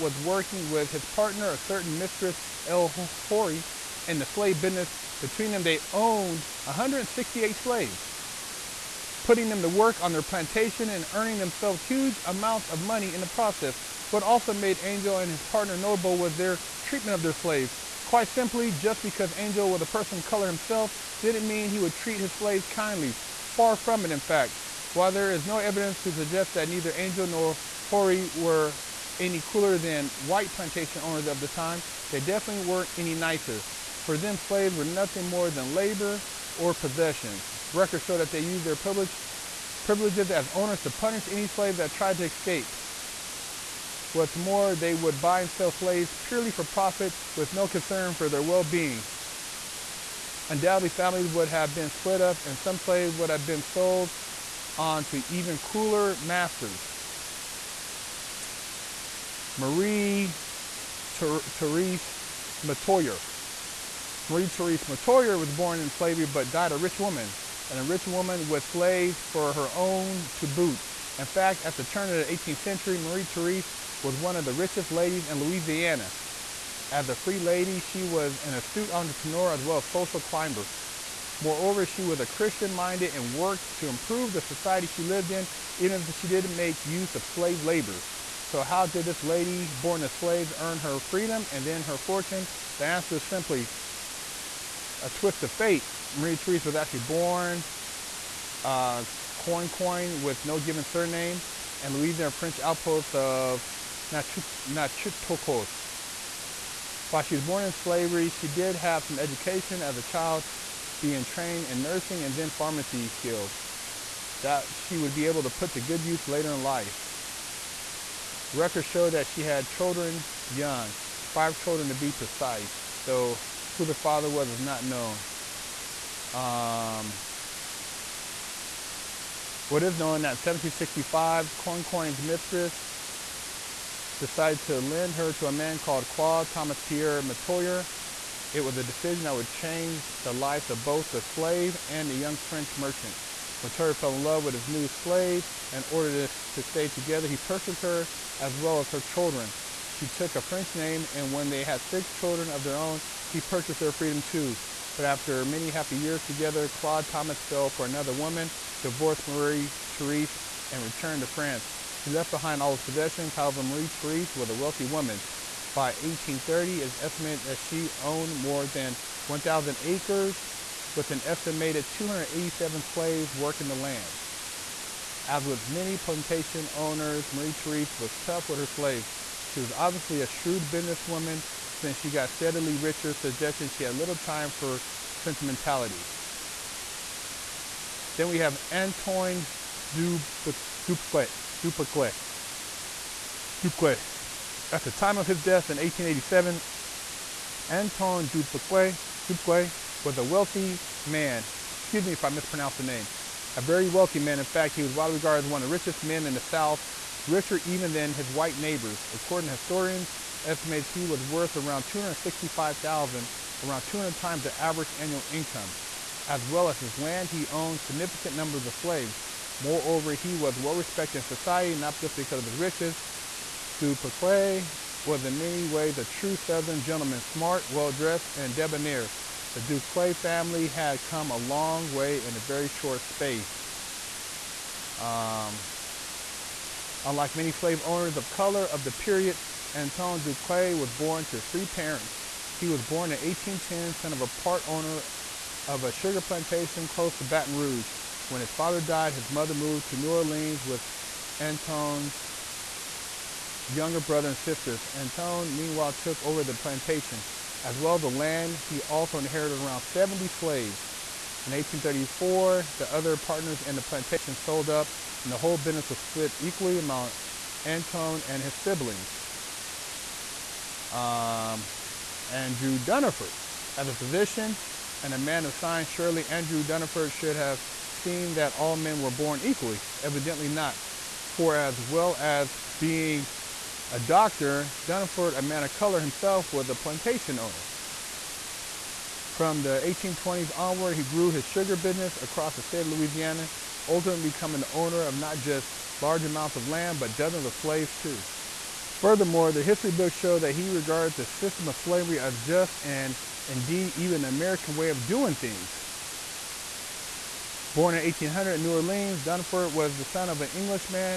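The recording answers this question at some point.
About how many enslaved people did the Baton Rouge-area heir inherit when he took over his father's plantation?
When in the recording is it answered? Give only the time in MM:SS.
04:19.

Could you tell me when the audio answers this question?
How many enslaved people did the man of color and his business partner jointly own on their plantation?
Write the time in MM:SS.
00:06.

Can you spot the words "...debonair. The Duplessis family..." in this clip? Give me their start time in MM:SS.
03:48.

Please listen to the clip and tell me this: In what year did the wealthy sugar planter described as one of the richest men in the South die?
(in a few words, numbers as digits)
1887.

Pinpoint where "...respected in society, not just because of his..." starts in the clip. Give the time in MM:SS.
03:40.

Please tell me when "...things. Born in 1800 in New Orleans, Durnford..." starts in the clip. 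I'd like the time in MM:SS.
05:05.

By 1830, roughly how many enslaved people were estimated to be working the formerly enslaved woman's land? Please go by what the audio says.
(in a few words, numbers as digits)
287.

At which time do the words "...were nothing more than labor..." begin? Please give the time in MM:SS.
00:34.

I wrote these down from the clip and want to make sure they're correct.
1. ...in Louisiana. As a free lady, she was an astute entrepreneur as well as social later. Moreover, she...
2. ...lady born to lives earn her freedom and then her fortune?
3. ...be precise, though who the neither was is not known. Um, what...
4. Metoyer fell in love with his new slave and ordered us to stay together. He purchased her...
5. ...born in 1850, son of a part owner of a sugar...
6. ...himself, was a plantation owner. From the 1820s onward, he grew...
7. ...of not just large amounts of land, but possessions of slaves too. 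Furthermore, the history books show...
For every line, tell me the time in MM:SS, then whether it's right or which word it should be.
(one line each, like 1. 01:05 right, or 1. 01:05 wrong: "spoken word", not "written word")
1. 01:15 wrong: "climber", not "later"
2. 01:29 wrong: "slaves", not "lives"
3. 02:01 wrong: "father", not "neither"
4. 02:23 right
5. 04:02 wrong: "1810", not "1850"
6. 04:46 right
7. 04:55 wrong: "dozens", not "possessions".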